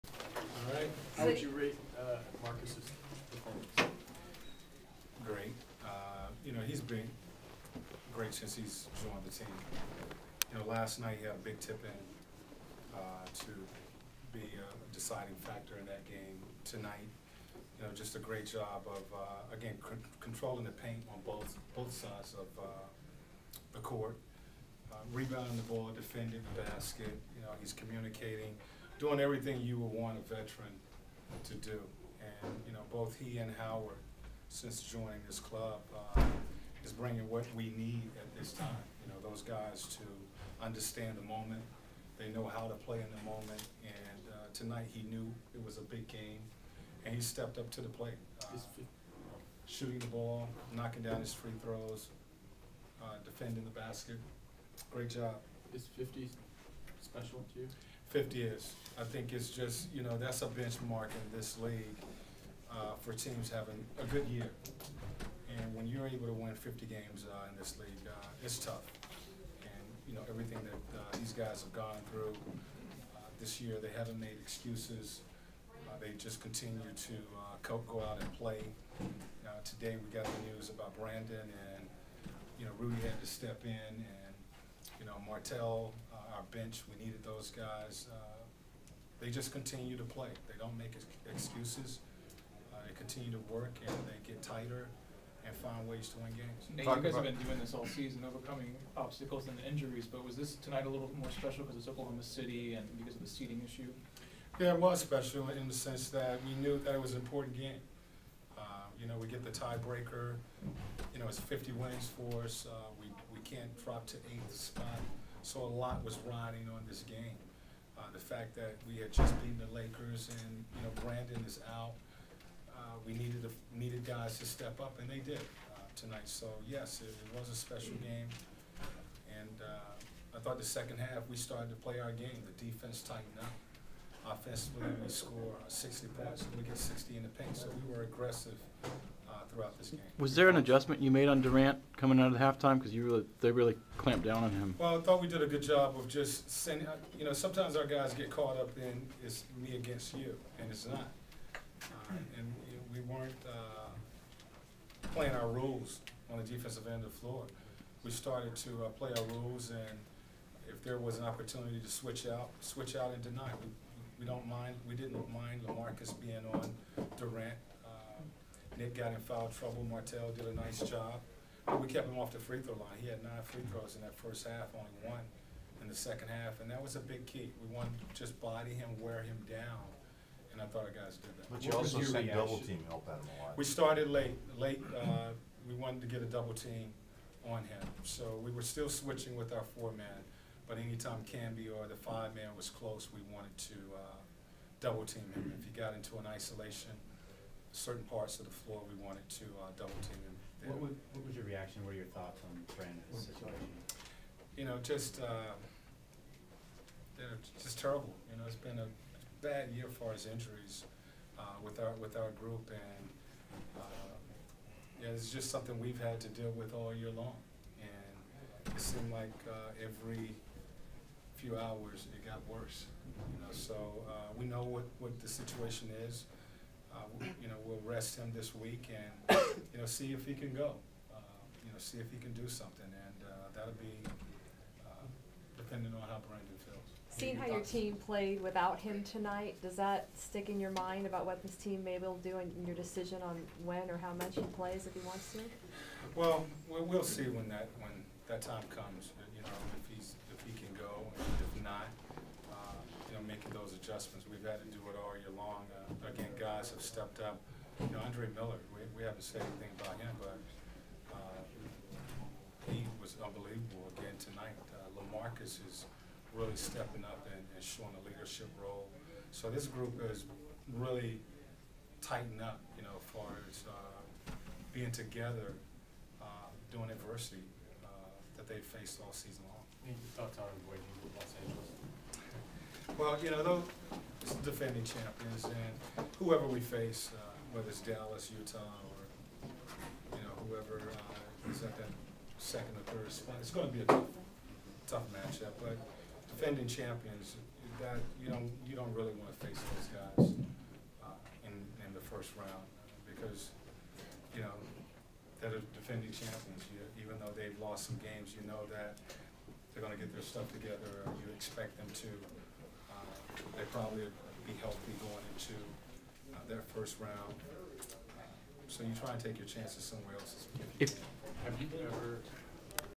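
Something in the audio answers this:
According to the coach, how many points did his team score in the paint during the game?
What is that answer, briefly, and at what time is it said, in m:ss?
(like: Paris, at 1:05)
60, at 2:16.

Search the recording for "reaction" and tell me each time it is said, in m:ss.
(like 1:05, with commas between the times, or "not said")
3:02, 3:21.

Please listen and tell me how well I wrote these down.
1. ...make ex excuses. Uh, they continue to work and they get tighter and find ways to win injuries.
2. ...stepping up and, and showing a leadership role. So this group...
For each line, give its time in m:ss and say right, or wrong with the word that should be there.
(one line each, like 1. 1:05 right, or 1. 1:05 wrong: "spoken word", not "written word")
1. 1:30 wrong: "games", not "injuries"
2. 4:26 right.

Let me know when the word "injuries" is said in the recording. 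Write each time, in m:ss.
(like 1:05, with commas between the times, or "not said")
1:39, 3:30.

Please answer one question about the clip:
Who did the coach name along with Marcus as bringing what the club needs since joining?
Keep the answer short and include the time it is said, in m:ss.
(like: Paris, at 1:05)
Howard, at 0:33.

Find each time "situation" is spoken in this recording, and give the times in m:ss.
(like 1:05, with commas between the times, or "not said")
3:23, 3:45.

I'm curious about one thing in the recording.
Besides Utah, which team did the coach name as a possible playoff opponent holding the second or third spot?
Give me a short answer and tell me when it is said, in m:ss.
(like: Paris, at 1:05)
Dallas, at 4:47.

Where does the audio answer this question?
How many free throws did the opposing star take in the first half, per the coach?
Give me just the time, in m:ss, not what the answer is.
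2:53.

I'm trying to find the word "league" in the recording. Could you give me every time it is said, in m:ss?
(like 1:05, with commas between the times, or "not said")
1:01, 1:07.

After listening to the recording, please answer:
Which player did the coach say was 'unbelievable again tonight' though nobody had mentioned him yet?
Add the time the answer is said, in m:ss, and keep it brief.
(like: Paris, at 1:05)
Andre Miller, at 4:18.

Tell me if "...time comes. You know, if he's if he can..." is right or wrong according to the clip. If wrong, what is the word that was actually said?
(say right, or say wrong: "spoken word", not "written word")
right.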